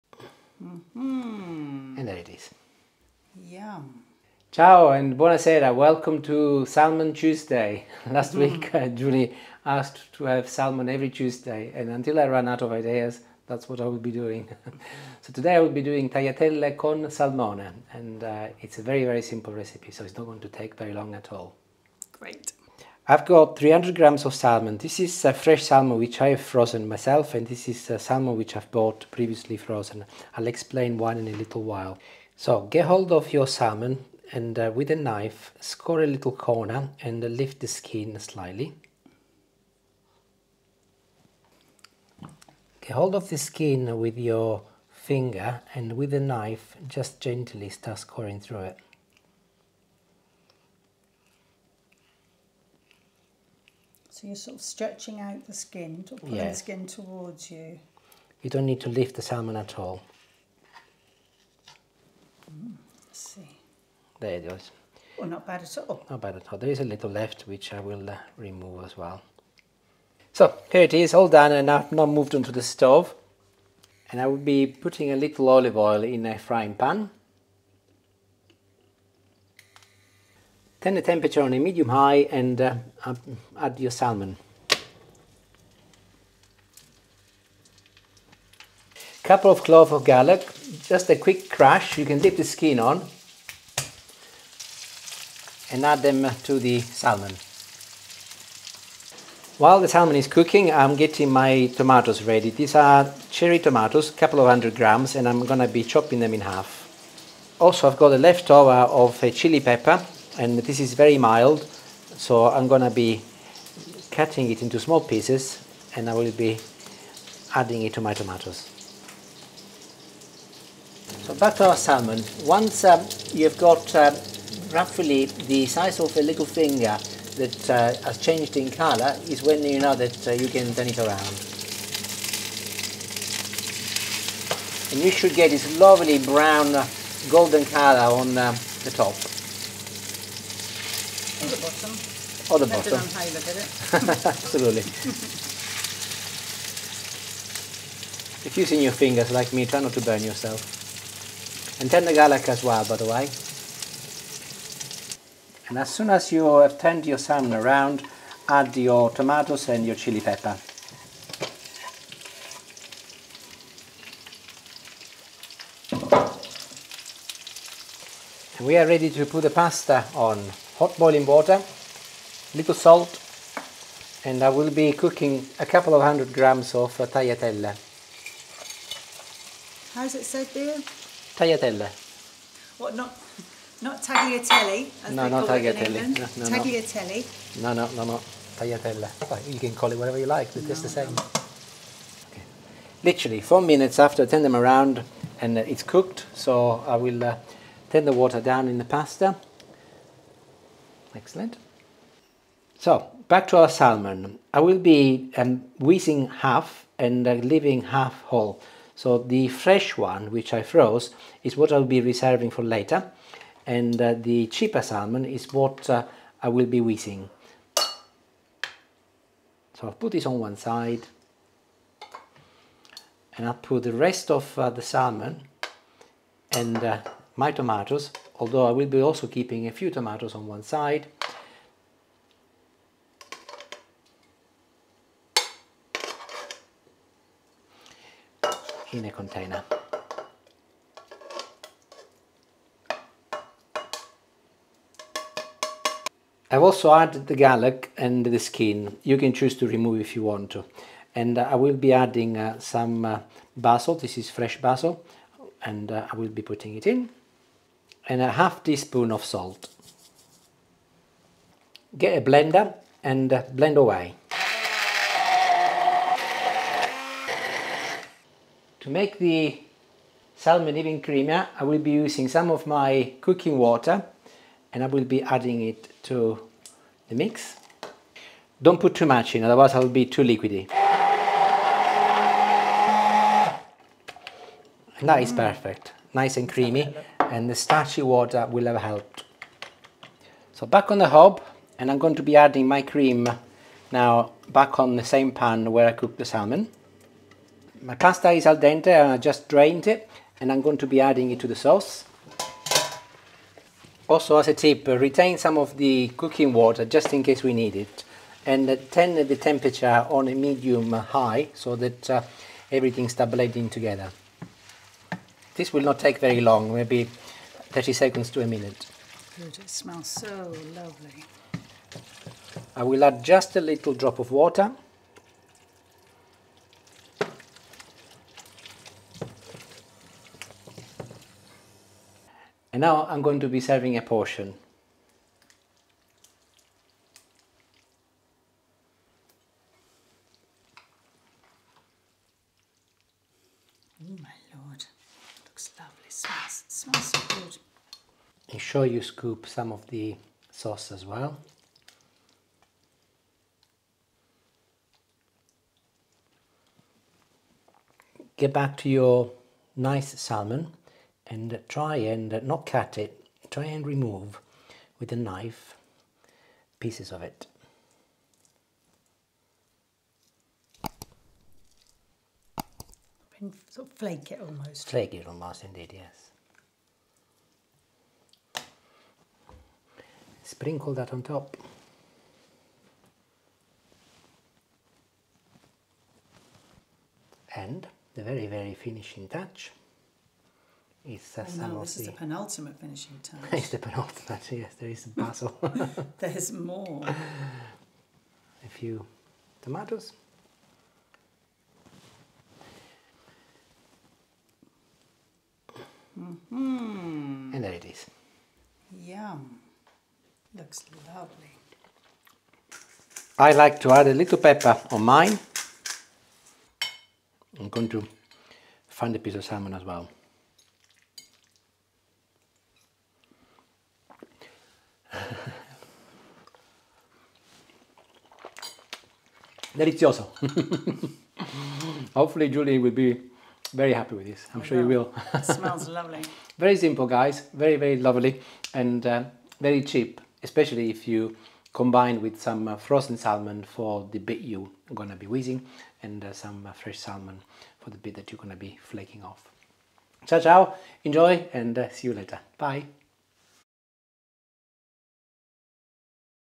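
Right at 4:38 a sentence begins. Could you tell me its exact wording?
Don't put too much in, otherwise I'll be too liquidy.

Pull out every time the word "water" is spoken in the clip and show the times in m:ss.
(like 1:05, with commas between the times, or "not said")
2:51, 3:18, 4:33, 4:48, 5:06, 5:24.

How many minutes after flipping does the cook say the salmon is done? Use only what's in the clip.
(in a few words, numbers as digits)
4.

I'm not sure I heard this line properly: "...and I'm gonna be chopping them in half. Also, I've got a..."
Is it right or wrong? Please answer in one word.
right.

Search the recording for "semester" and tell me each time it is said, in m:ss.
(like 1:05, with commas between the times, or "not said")
not said.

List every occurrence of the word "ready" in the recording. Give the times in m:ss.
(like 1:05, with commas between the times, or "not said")
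1:42, 2:48.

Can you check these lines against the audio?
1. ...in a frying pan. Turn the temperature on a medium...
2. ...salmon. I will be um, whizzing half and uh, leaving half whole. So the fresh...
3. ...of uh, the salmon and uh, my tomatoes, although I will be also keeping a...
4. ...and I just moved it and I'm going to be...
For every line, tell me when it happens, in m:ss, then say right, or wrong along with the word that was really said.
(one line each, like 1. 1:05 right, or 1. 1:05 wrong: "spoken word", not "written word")
1. 1:16 right
2. 3:23 right
3. 3:44 right
4. 4:58 wrong: "drained", not "moved".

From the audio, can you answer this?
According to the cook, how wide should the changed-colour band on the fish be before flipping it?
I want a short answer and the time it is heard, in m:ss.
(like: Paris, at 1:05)
Little finger, at 2:06.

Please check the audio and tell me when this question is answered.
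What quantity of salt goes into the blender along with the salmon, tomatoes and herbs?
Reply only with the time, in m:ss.
4:18.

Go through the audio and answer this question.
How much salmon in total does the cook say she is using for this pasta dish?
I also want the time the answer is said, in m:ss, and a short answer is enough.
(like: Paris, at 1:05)
300 grams, at 0:23.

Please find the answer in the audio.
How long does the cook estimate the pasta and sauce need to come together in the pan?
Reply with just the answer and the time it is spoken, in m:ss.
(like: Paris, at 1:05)
30 seconds to a minute, at 5:17.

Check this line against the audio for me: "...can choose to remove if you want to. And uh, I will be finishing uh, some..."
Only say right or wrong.
wrong.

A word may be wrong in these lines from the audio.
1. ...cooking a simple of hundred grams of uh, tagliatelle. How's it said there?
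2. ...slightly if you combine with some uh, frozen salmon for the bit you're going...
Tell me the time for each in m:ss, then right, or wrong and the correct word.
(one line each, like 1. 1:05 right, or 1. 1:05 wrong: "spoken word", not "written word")
1. 2:54 wrong: "couple", not "simple"
2. 7:20 wrong: "especially", not "slightly".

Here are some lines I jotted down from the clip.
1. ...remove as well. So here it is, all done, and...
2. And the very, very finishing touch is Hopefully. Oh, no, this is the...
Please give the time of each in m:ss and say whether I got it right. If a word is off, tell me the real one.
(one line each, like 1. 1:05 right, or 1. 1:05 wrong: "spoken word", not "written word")
1. 1:08 right
2. 6:27 wrong: "Sasamossi", not "Hopefully".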